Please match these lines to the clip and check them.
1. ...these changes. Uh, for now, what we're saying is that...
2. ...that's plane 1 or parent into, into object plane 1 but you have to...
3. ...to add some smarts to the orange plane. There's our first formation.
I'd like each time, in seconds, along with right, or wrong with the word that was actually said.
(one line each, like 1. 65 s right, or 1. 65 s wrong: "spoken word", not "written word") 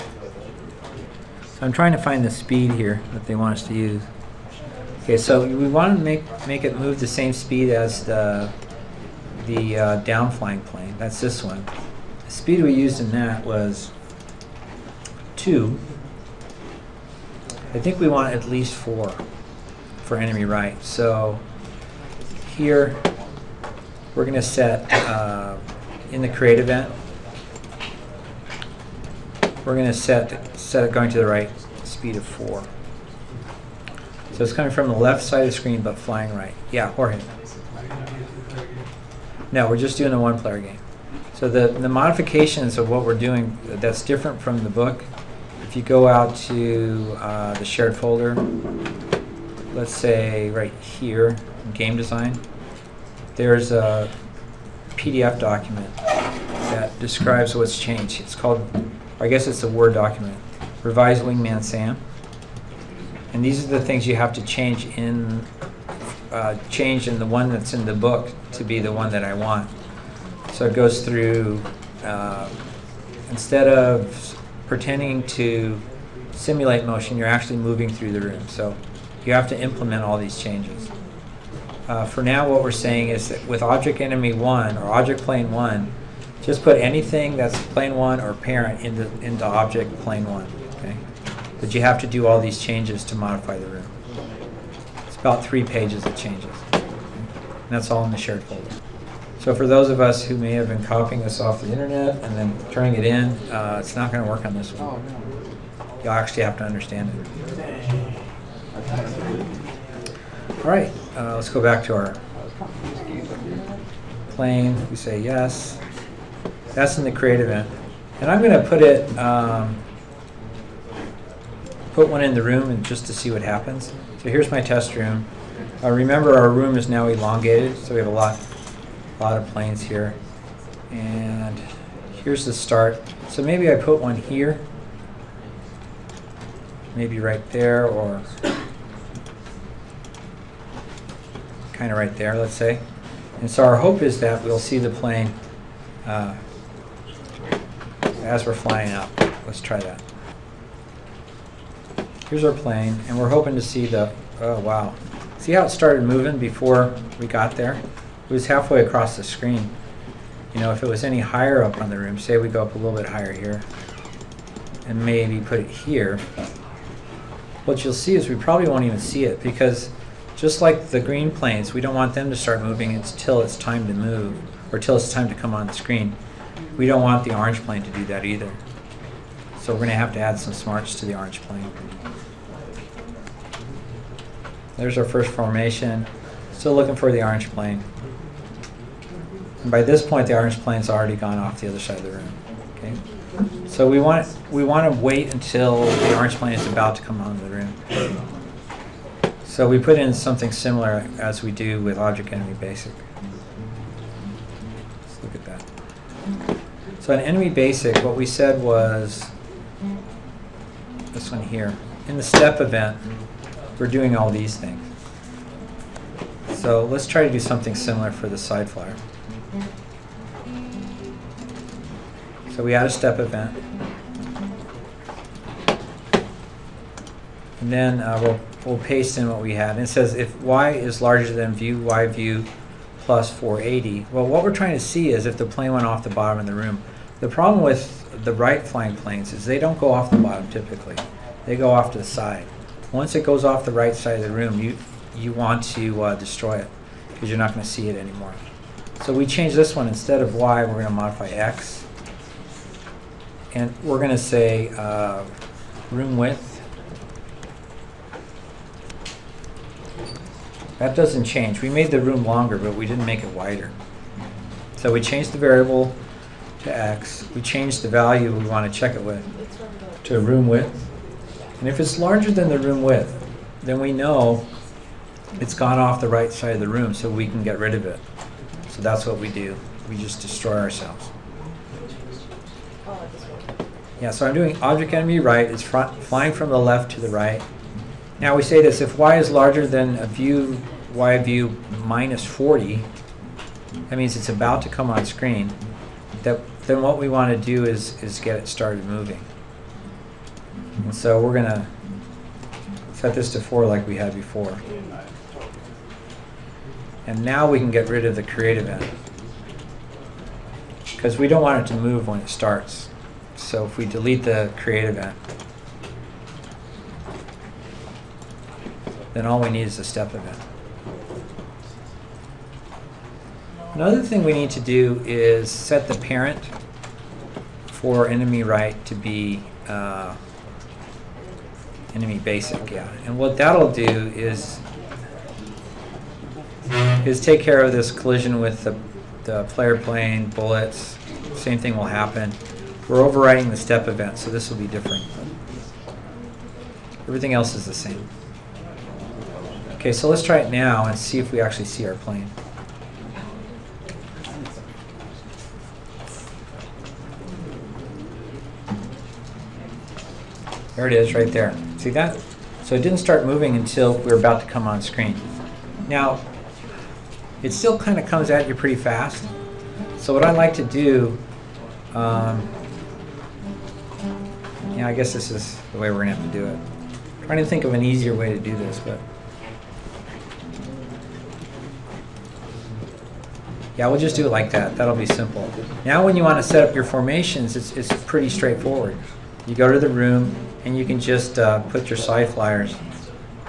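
1. 80 s right
2. 87 s right
3. 180 s right.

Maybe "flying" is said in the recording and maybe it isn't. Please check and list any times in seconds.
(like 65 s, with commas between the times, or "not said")
10 s, 35 s, 148 s, 238 s, 285 s.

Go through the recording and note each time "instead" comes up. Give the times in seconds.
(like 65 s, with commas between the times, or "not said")
30 s, 73 s, 249 s.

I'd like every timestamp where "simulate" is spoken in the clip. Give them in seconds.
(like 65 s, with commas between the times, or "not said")
76 s.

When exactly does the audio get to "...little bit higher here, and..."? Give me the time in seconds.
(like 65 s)
162 s.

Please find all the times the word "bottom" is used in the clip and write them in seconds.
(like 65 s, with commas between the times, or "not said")
236 s, 240 s.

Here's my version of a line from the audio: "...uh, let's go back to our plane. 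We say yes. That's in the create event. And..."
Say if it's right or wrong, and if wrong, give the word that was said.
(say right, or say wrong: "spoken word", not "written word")
right.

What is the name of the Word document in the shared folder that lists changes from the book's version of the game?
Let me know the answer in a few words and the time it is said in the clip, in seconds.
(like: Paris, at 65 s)
Revise Wingman Sam, at 60 s.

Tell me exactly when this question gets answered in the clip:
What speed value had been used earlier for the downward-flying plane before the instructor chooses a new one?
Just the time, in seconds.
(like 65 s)
12 s.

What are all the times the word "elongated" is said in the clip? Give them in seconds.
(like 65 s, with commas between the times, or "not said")
127 s.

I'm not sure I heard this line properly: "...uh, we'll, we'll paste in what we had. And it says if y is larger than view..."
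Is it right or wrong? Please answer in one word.
right.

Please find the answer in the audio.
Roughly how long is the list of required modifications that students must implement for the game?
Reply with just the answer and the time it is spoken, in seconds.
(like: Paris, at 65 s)
About three pages, at 95 s.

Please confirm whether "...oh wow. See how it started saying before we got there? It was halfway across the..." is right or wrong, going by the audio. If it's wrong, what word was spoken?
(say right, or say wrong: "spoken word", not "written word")
wrong: "moving", not "saying".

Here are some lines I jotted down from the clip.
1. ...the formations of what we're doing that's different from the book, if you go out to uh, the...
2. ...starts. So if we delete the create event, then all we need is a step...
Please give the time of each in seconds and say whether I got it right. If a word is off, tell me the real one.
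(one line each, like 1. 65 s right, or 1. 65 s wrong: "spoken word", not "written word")
1. 41 s wrong: "modifications", not "formations"
2. 312 s right.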